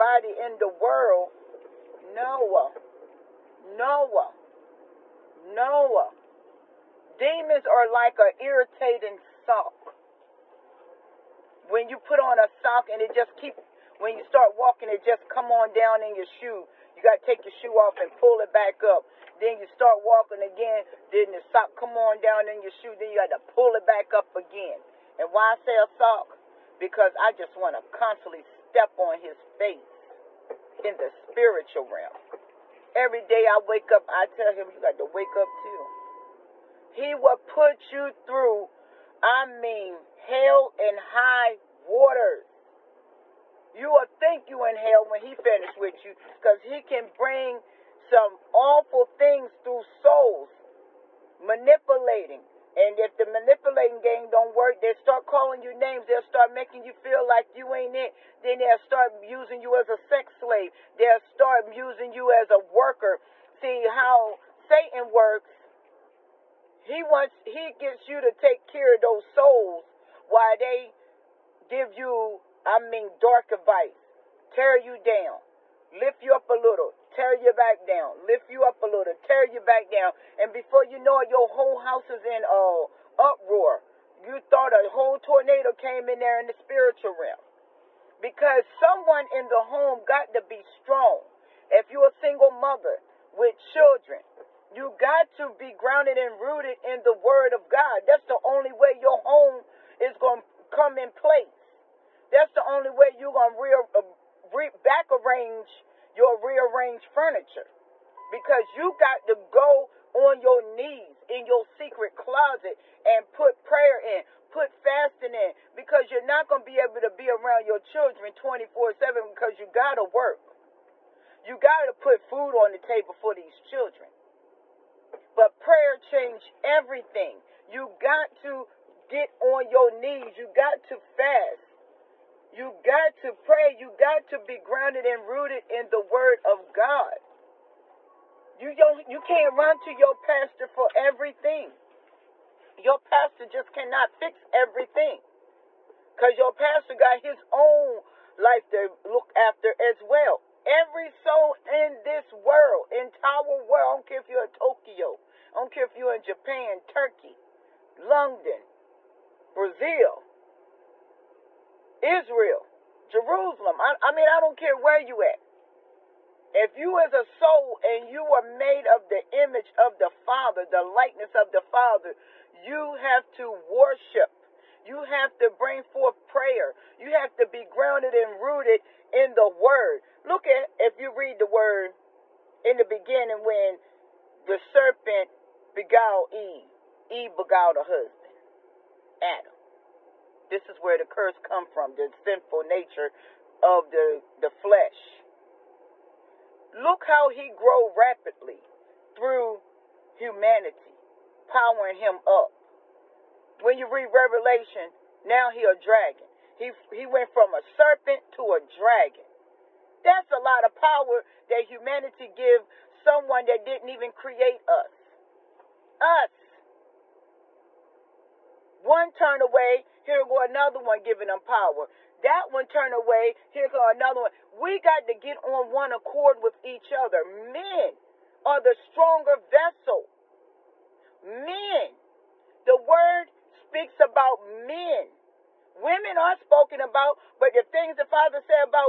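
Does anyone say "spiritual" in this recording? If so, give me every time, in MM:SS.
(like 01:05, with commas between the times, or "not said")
00:31, 01:26.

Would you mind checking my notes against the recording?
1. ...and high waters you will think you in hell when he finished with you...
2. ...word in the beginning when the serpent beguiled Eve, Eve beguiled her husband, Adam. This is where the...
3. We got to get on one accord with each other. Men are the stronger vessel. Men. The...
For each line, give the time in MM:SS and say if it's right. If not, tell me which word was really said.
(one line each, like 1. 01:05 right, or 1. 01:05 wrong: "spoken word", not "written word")
1. 00:40 right
2. 03:01 right
3. 03:44 right.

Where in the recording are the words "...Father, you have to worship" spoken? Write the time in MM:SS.
02:51.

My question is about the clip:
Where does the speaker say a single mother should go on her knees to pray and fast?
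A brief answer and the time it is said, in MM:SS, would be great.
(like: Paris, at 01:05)
Secret closet, at 01:51.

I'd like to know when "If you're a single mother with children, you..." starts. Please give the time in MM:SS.
01:31.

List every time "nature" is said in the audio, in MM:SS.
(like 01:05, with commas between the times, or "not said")
03:12.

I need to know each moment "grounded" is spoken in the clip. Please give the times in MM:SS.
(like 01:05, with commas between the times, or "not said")
01:35, 02:14, 02:57.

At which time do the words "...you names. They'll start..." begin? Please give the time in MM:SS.
00:55.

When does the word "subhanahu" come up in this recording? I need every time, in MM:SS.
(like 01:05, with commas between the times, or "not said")
not said.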